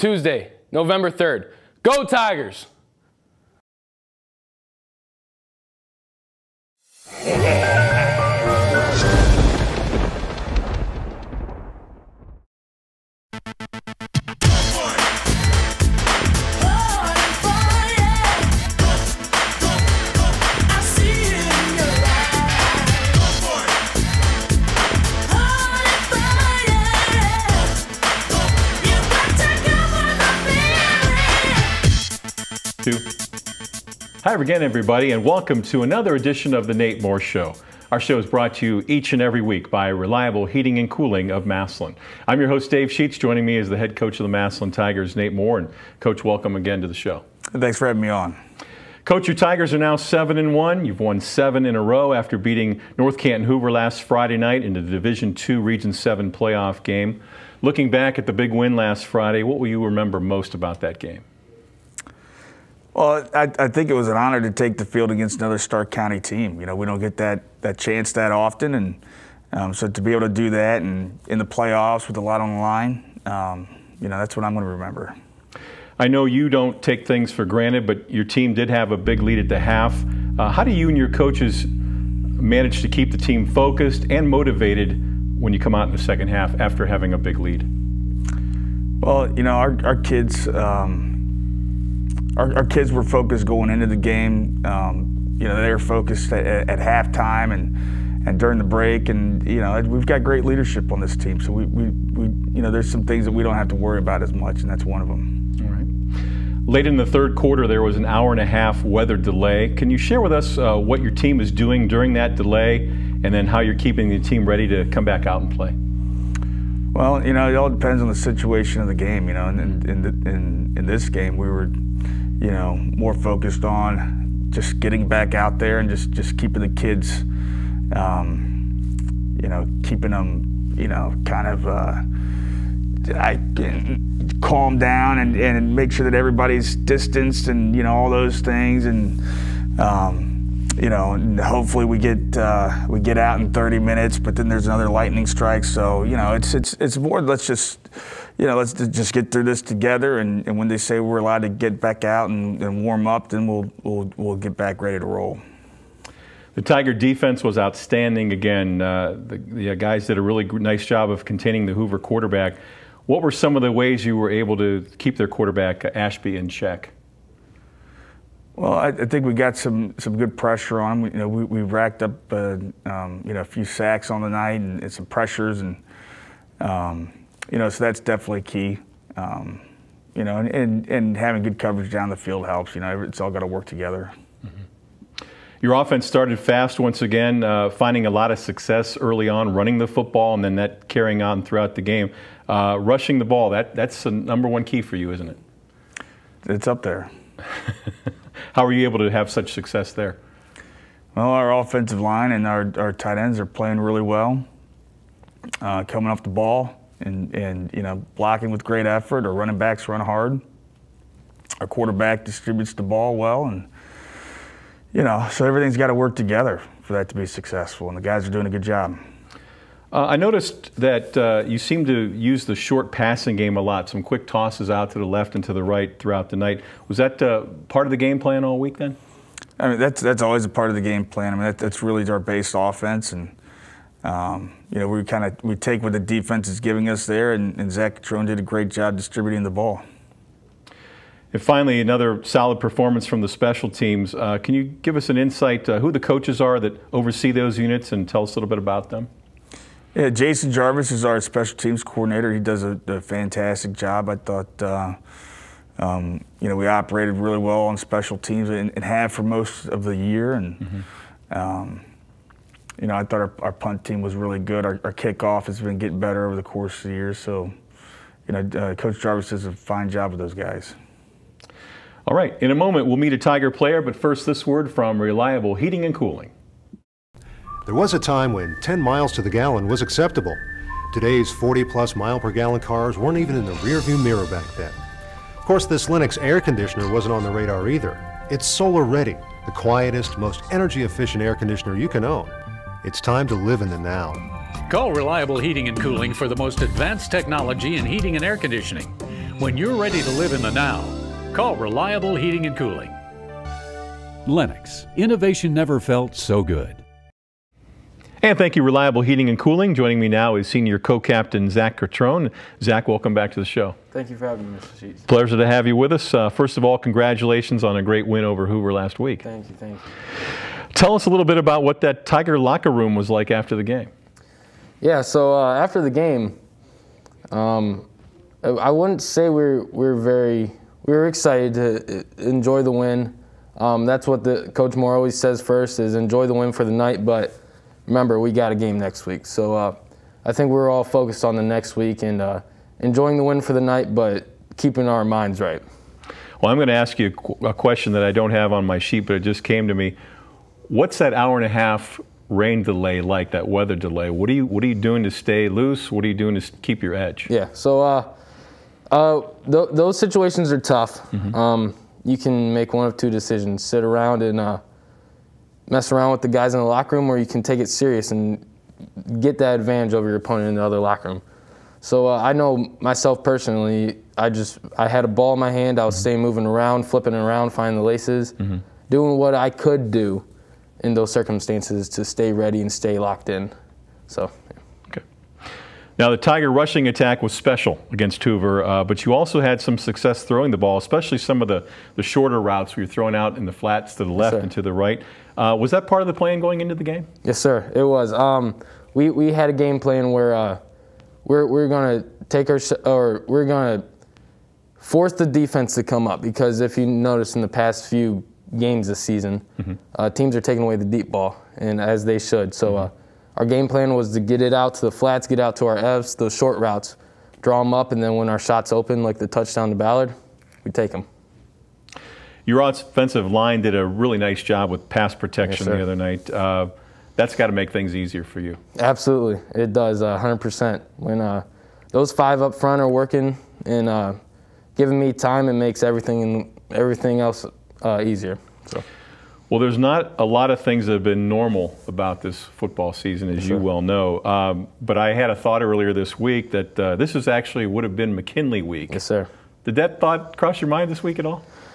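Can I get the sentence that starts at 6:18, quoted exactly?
doing what I could do in those circumstances to stay ready and stay locked in.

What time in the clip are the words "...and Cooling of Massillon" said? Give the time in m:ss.
0:40.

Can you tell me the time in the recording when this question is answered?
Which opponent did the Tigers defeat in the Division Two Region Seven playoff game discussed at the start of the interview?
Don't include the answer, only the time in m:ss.
0:52.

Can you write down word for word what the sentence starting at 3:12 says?
Uh, rushing the ball, that, that's the number one key for you, isn't it?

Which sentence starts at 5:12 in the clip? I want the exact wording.
Zach, welcome back to the show.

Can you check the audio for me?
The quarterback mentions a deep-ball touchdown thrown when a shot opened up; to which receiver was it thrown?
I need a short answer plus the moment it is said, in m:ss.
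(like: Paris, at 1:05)
Ballard, at 6:59.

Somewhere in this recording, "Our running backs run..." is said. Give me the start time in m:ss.
3:29.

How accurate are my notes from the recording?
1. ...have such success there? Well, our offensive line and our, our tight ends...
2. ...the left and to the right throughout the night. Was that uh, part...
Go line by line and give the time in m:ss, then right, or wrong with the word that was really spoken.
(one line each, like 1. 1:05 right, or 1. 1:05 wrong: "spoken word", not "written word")
1. 3:19 right
2. 3:44 right.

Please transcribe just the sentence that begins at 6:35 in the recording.
Uh, was that part of the plan going into the game?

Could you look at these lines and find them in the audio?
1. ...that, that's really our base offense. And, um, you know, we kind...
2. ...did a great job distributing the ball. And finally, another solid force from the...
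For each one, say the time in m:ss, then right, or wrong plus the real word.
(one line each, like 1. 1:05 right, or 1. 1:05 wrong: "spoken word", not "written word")
1. 3:51 right
2. 3:58 wrong: "performance", not "force".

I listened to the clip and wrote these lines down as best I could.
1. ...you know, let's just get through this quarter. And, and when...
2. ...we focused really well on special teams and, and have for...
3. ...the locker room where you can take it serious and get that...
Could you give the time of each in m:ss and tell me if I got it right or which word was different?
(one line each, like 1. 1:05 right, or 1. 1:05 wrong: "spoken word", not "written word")
1. 2:28 wrong: "together", not "quarter"
2. 4:16 wrong: "operated", not "focused"
3. 6:06 right.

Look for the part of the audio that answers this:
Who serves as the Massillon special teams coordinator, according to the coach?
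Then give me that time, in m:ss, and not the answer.
4:10.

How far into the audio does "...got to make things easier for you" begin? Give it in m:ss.
7:07.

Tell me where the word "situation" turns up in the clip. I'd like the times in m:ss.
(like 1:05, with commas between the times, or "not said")
1:58, 5:59.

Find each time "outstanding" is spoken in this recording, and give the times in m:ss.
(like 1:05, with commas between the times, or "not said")
2:37.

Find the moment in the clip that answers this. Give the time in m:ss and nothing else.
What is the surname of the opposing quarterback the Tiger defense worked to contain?
2:45.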